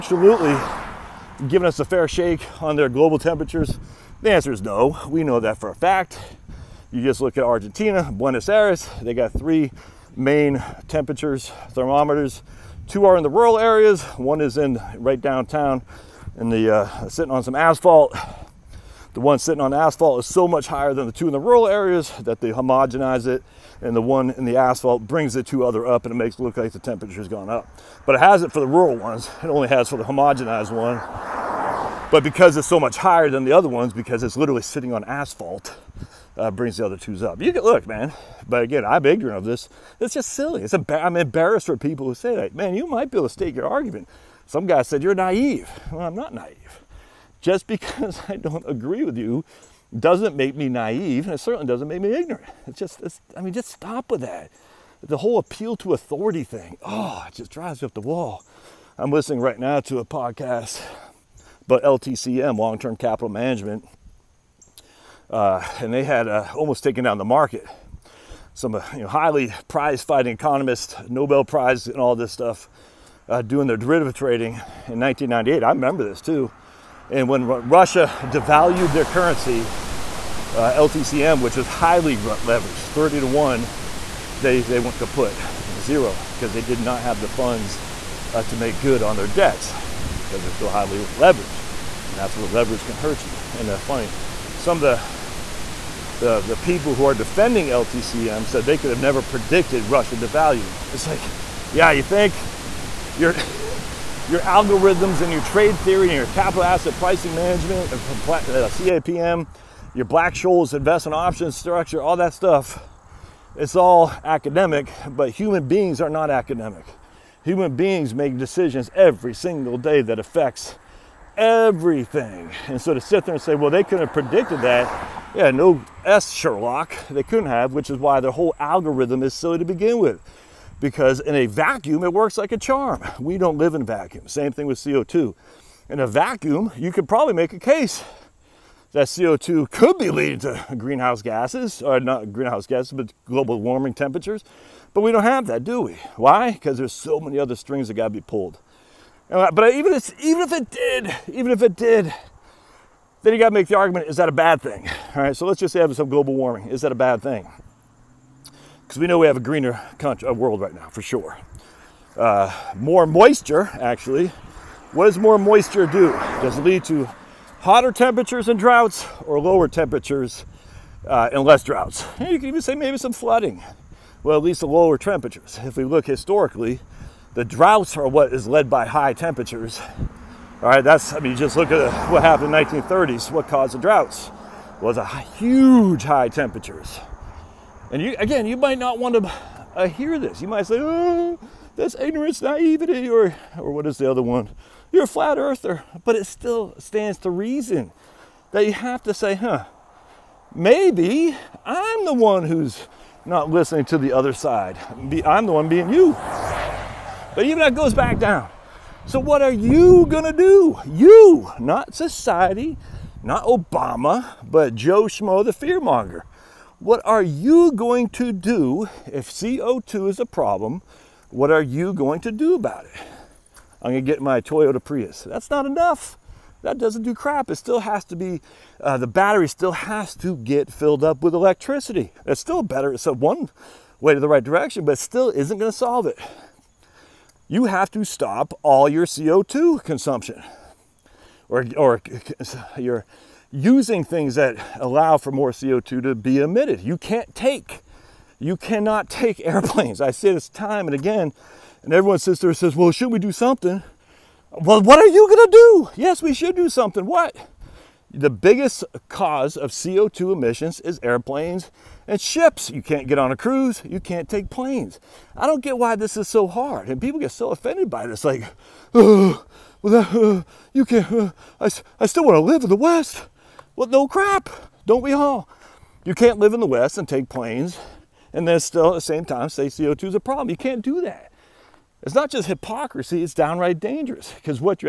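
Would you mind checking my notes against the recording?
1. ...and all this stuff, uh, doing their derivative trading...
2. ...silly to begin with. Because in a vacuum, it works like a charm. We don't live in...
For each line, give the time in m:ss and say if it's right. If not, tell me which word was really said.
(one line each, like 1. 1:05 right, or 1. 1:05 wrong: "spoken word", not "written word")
1. 1:11 right
2. 2:09 right.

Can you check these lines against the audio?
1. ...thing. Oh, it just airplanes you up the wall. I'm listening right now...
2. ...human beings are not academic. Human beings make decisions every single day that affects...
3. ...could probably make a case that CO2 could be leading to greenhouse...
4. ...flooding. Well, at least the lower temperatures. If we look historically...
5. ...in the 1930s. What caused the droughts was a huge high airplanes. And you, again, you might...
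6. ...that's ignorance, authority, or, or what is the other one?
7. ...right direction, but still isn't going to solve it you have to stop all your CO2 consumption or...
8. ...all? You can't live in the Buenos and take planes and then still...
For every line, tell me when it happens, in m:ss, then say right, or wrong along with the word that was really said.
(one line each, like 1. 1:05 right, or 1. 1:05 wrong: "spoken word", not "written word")
1. 0:56 wrong: "drives", not "airplanes"
2. 1:55 right
3. 2:16 right
4. 2:53 right
5. 3:02 wrong: "temperatures", not "airplanes"
6. 3:11 wrong: "naivety", not "authority"
7. 3:54 right
8. 4:35 wrong: "West", not "Buenos".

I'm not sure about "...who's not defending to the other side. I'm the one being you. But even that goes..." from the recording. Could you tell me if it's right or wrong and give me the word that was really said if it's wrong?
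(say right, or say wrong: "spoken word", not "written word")
wrong: "listening", not "defending".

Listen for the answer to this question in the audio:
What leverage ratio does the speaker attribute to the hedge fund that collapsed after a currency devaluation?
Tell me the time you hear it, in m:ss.
1:22.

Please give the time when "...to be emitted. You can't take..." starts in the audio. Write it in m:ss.
4:06.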